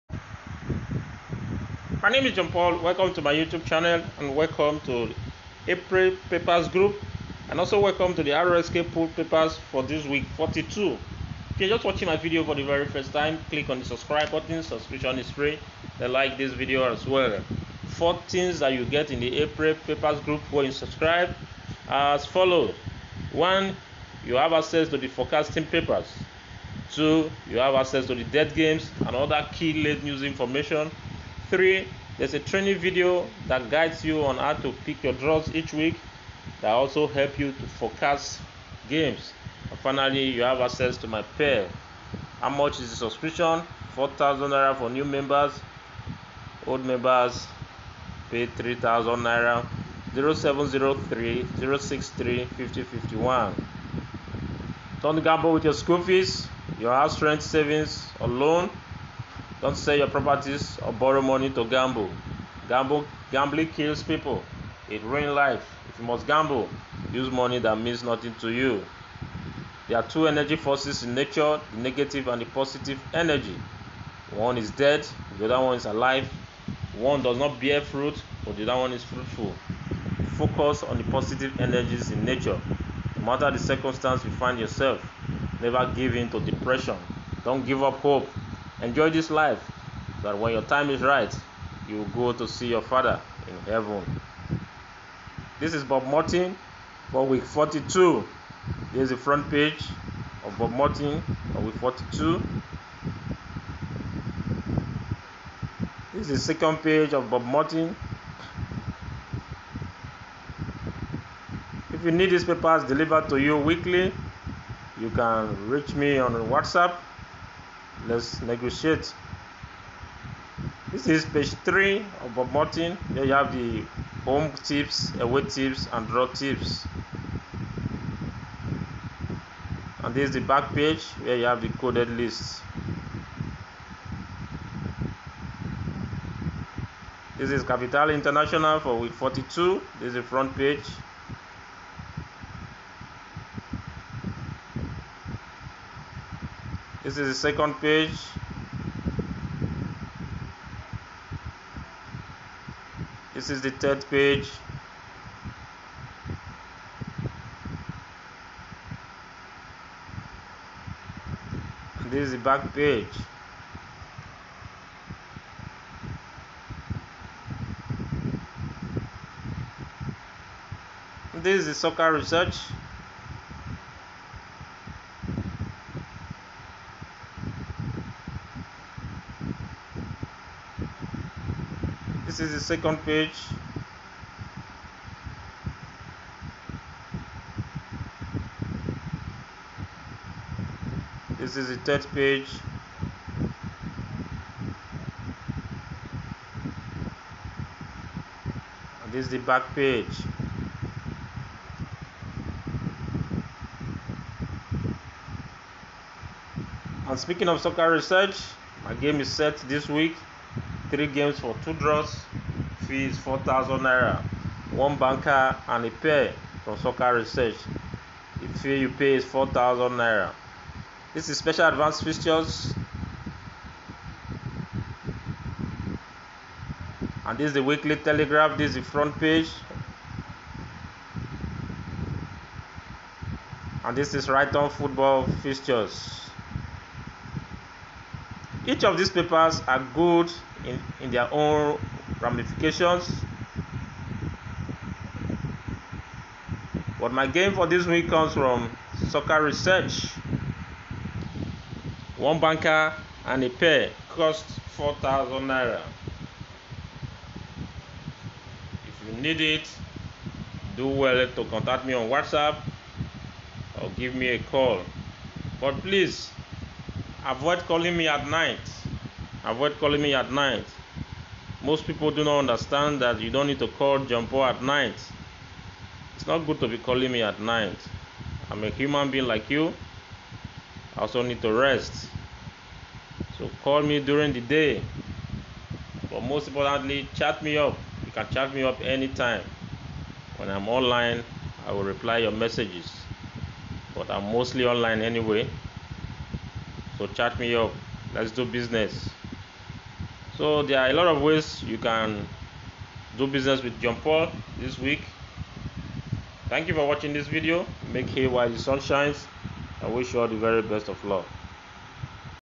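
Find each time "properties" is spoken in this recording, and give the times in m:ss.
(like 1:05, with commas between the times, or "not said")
1:00.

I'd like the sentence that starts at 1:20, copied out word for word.
Focus on the positive energies in nature.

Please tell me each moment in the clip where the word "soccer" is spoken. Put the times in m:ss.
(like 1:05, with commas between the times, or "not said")
2:51, 3:27, 3:36, 4:09.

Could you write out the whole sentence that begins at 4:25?
But please avoid calling me at night.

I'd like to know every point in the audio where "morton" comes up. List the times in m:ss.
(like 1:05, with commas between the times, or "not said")
1:36, 1:40, 1:47, 2:02.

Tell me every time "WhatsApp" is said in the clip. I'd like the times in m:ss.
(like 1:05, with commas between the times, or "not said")
1:56, 4:22.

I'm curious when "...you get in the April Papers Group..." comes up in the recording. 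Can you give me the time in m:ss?
0:18.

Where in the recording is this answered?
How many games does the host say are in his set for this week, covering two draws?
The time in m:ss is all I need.
3:30.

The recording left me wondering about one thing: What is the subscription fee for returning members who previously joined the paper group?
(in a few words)
3,000 naira.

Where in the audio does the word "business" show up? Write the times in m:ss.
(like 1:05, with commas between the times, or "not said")
4:58, 5:03.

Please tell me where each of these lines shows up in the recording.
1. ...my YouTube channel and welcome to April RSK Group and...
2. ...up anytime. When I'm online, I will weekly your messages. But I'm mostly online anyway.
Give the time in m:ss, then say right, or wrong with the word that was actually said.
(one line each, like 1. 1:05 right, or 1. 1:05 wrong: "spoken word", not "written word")
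1. 0:03 wrong: "Papers", not "RSK"
2. 4:48 wrong: "reply", not "weekly".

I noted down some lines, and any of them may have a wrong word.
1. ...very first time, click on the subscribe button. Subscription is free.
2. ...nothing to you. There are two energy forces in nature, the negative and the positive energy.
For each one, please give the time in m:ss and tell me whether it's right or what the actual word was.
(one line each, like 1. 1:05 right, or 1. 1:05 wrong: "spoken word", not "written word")
1. 0:12 right
2. 1:08 right.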